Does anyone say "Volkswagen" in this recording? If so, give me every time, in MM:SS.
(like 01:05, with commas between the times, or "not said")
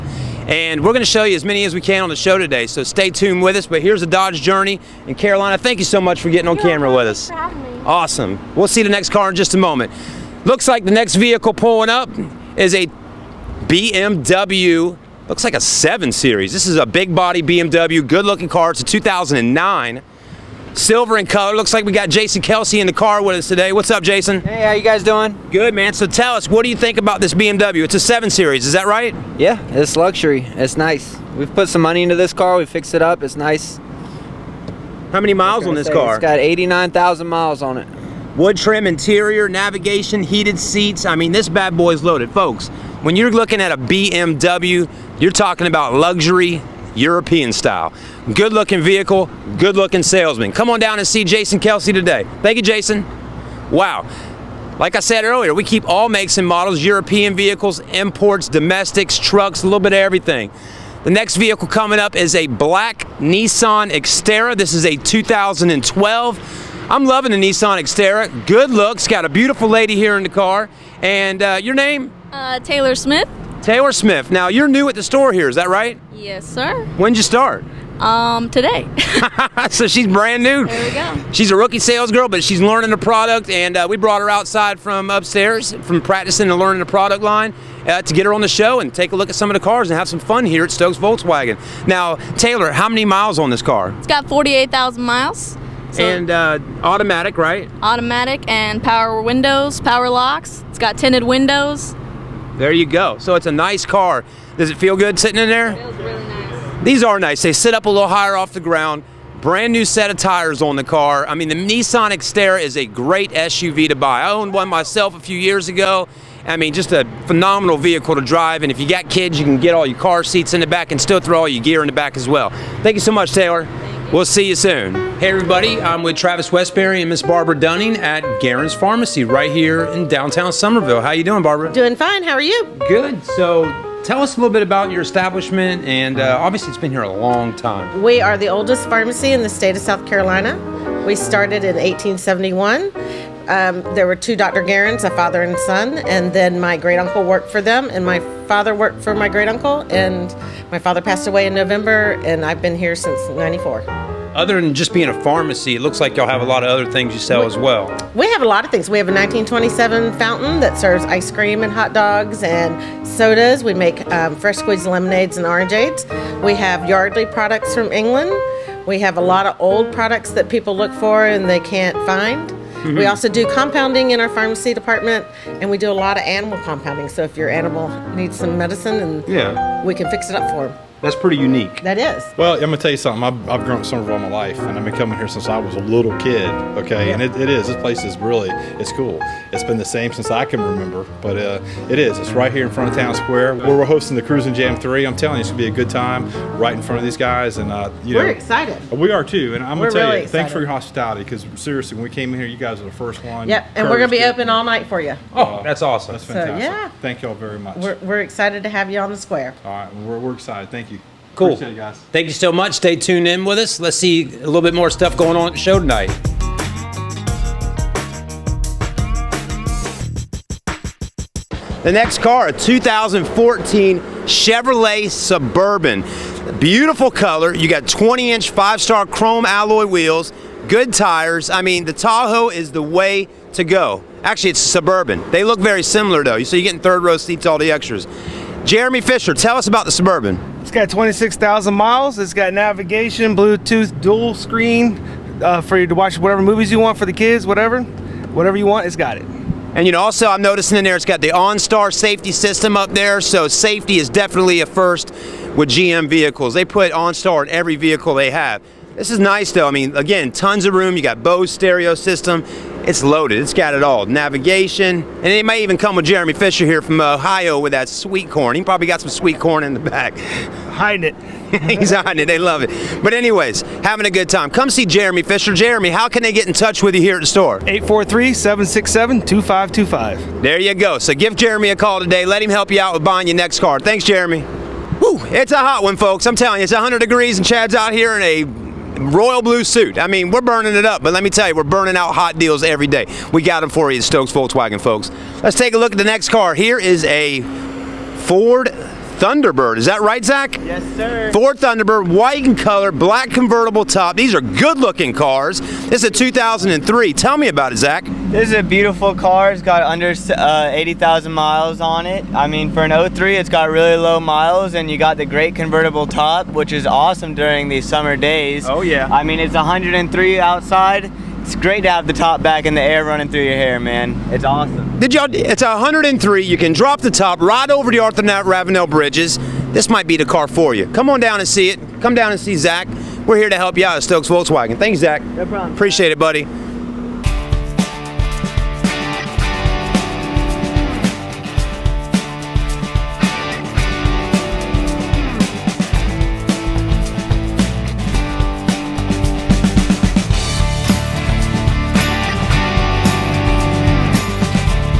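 01:30, 04:54, 05:34.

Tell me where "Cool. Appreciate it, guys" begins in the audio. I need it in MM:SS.
03:31.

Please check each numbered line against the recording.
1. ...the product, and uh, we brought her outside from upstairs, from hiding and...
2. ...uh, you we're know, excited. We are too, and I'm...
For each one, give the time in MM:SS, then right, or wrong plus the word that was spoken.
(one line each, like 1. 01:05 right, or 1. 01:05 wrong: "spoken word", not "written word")
1. 01:22 wrong: "practicing", not "hiding"
2. 03:17 right.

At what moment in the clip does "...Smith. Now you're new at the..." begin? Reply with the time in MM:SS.
01:13.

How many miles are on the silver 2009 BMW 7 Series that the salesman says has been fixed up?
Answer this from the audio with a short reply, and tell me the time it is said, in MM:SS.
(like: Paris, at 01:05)
89,000, at 00:36.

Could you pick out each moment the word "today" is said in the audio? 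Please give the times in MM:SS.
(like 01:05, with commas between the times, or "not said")
00:02, 00:23, 00:51, 01:18, 04:41.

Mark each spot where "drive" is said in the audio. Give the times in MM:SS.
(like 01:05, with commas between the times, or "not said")
01:58.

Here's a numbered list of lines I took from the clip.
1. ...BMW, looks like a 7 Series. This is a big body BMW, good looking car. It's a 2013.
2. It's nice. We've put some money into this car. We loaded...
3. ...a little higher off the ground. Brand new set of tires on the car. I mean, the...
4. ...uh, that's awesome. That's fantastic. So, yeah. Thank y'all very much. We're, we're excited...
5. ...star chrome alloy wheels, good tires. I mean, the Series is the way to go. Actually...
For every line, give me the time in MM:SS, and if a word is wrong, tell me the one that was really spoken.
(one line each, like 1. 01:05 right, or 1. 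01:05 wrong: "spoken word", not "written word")
1. 00:13 wrong: "2009", not "2013"
2. 00:30 wrong: "fixed", not "loaded"
3. 01:47 right
4. 03:25 right
5. 03:48 wrong: "Tahoe", not "Series".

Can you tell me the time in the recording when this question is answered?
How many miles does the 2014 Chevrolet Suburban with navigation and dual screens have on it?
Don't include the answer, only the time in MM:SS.
04:00.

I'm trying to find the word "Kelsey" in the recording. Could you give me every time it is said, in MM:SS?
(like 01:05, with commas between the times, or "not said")
00:22, 00:51.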